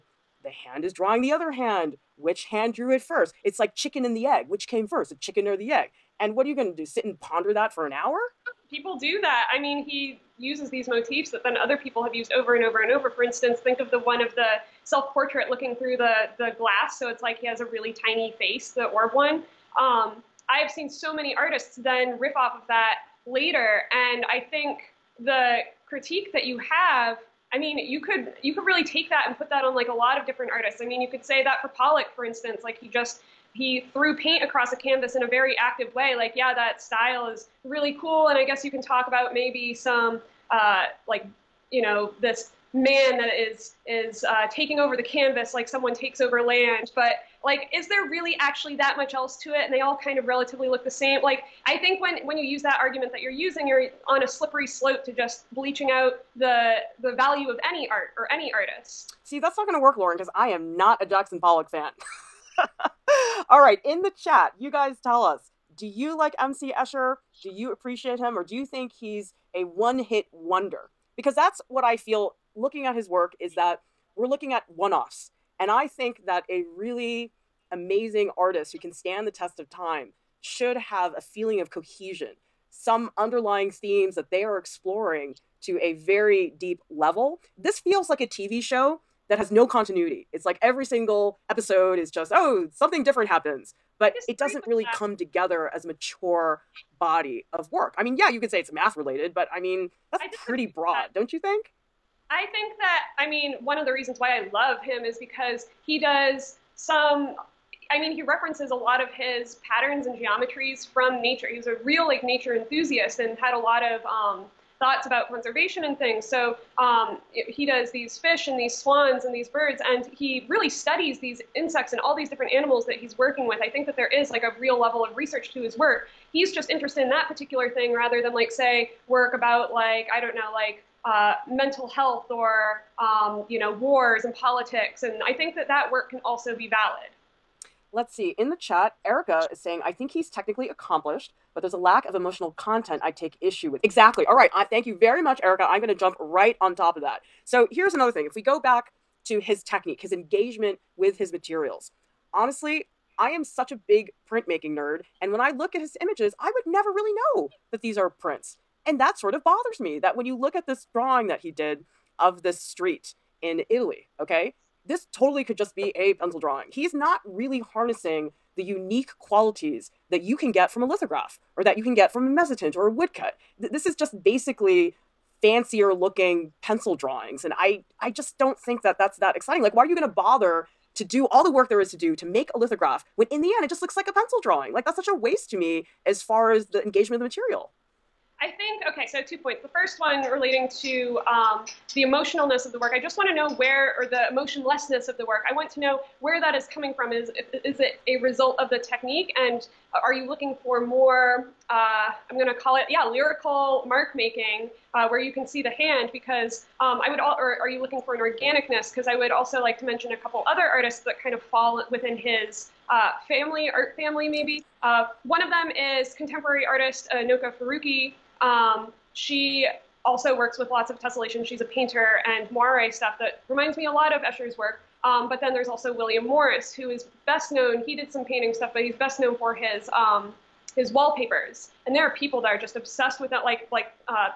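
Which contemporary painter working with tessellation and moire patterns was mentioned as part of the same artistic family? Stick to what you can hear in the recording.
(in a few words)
Noka Faruqee.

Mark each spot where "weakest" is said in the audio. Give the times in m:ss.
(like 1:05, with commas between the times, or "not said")
not said.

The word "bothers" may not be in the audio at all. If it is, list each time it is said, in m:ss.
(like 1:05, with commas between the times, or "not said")
2:39, 3:00.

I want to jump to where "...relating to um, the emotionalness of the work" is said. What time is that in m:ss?
3:10.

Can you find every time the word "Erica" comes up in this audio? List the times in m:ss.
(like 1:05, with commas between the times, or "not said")
2:19, 2:25.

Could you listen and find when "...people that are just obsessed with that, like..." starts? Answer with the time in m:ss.
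3:52.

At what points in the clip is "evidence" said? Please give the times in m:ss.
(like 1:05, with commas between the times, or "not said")
not said.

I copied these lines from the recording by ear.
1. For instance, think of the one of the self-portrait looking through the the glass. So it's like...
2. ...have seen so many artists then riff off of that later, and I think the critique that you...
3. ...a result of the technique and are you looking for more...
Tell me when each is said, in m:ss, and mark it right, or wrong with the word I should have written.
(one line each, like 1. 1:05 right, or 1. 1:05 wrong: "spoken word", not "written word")
1. 0:13 right
2. 0:20 right
3. 3:18 right.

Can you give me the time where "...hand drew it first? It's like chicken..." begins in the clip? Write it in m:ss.
0:02.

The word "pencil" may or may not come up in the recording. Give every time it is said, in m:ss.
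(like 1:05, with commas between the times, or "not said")
2:46, 2:56, 3:04.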